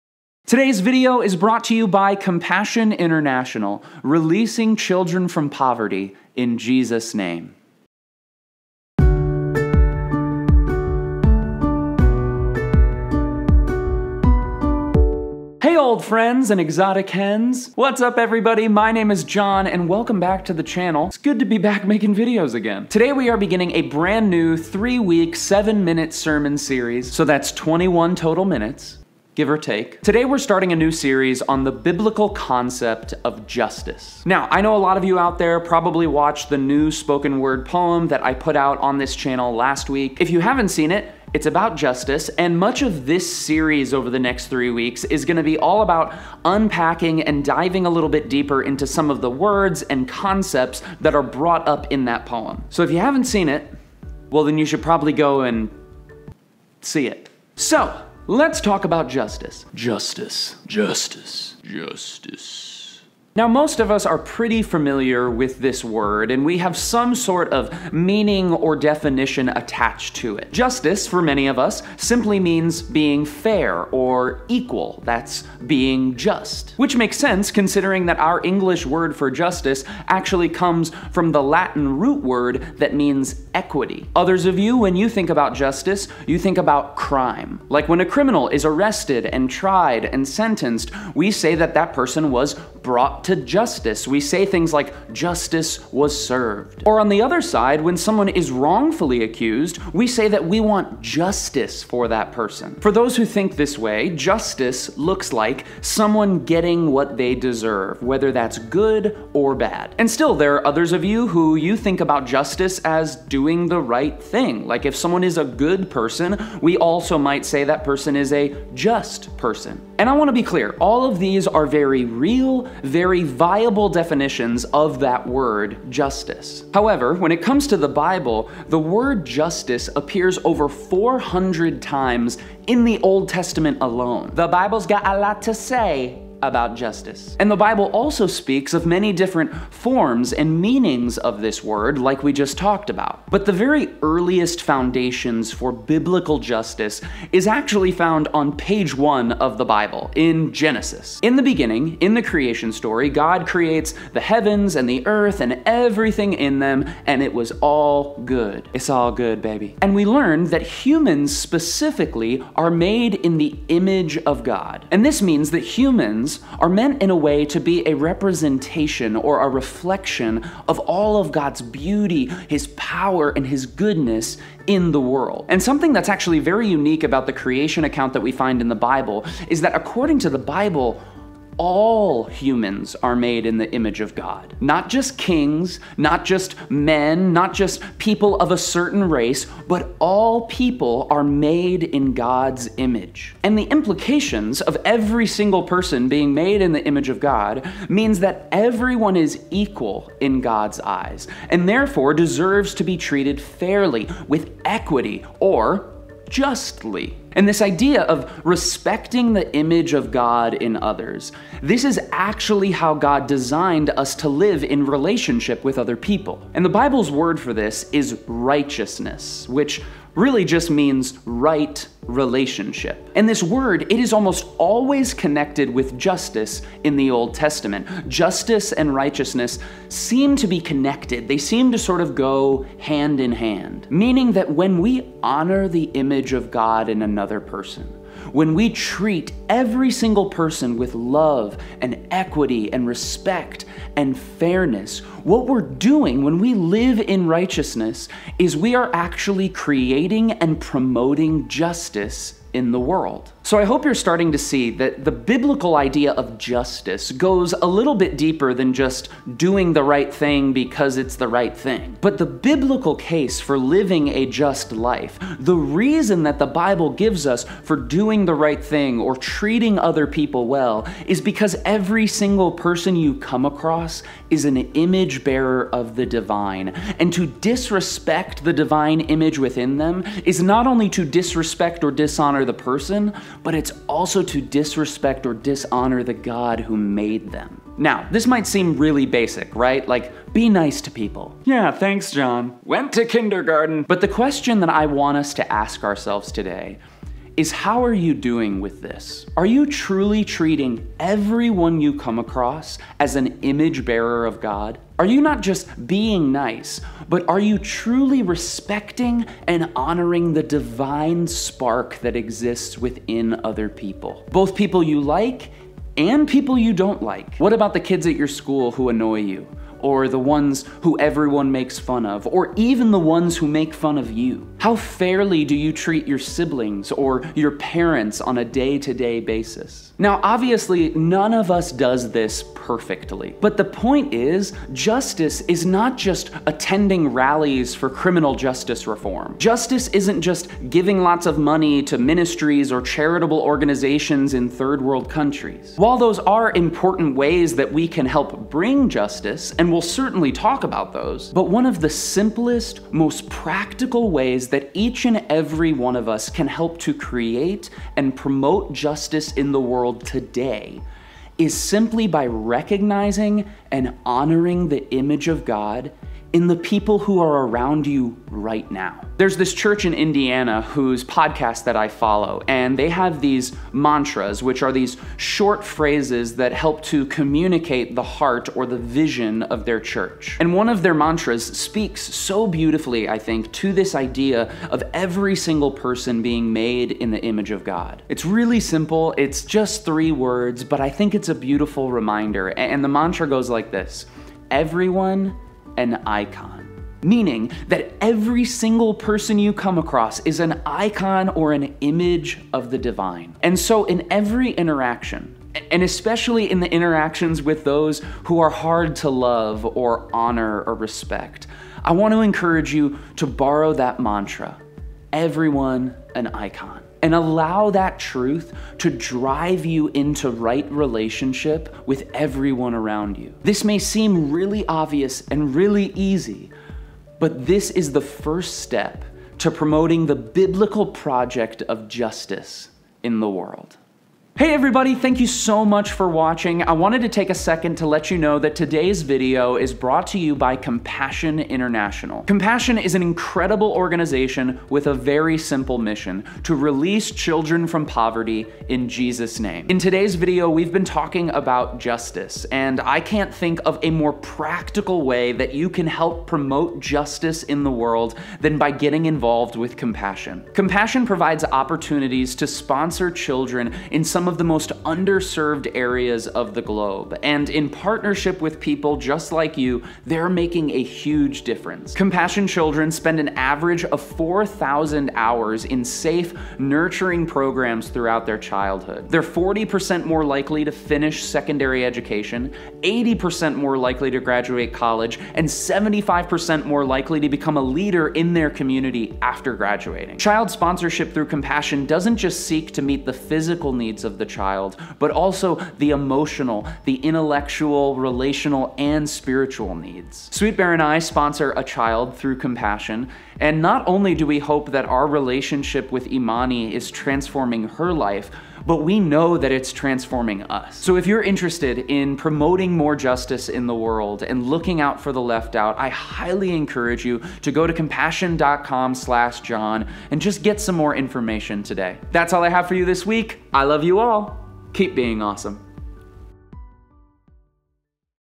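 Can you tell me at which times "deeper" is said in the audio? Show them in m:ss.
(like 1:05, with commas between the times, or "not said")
0:48, 4:18.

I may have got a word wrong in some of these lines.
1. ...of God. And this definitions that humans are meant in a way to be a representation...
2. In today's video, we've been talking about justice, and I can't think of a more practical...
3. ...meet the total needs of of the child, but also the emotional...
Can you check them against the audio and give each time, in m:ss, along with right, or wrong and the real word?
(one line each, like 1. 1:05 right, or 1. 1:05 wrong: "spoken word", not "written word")
1. 2:44 wrong: "means", not "definitions"
2. 7:29 right
3. 8:12 wrong: "physical", not "total".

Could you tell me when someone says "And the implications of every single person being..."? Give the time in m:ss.
3:13.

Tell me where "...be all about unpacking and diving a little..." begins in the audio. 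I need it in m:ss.
0:45.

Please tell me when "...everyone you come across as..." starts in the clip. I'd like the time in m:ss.
5:00.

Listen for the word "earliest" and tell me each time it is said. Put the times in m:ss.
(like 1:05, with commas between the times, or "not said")
2:24.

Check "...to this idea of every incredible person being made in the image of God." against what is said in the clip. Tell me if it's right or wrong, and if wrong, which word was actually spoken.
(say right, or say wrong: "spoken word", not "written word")
wrong: "single", not "incredible".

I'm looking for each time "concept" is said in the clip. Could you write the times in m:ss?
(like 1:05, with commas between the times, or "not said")
0:32, 0:50.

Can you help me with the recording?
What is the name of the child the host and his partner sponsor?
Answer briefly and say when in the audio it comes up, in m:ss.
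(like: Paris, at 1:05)
Imani, at 8:26.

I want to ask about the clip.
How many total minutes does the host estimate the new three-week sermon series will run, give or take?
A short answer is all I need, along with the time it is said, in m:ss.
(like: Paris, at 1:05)
21, at 0:27.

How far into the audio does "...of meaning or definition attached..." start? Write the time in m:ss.
1:07.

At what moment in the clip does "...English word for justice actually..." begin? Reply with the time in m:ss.
1:18.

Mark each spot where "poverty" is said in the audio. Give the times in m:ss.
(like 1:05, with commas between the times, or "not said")
0:05, 7:27.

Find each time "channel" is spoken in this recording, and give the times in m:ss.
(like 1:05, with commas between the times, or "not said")
0:20, 0:39.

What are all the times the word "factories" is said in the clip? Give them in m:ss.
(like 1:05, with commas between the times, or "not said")
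not said.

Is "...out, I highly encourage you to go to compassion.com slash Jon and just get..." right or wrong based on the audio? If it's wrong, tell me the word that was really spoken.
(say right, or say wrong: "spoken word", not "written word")
right.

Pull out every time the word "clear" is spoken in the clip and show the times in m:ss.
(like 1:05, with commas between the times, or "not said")
2:00.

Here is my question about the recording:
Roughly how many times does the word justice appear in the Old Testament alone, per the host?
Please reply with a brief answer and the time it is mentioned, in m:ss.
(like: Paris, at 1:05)
over 400, at 2:10.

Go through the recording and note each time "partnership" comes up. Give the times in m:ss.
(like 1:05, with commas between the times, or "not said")
7:47.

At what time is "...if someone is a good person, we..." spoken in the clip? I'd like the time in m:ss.
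1:54.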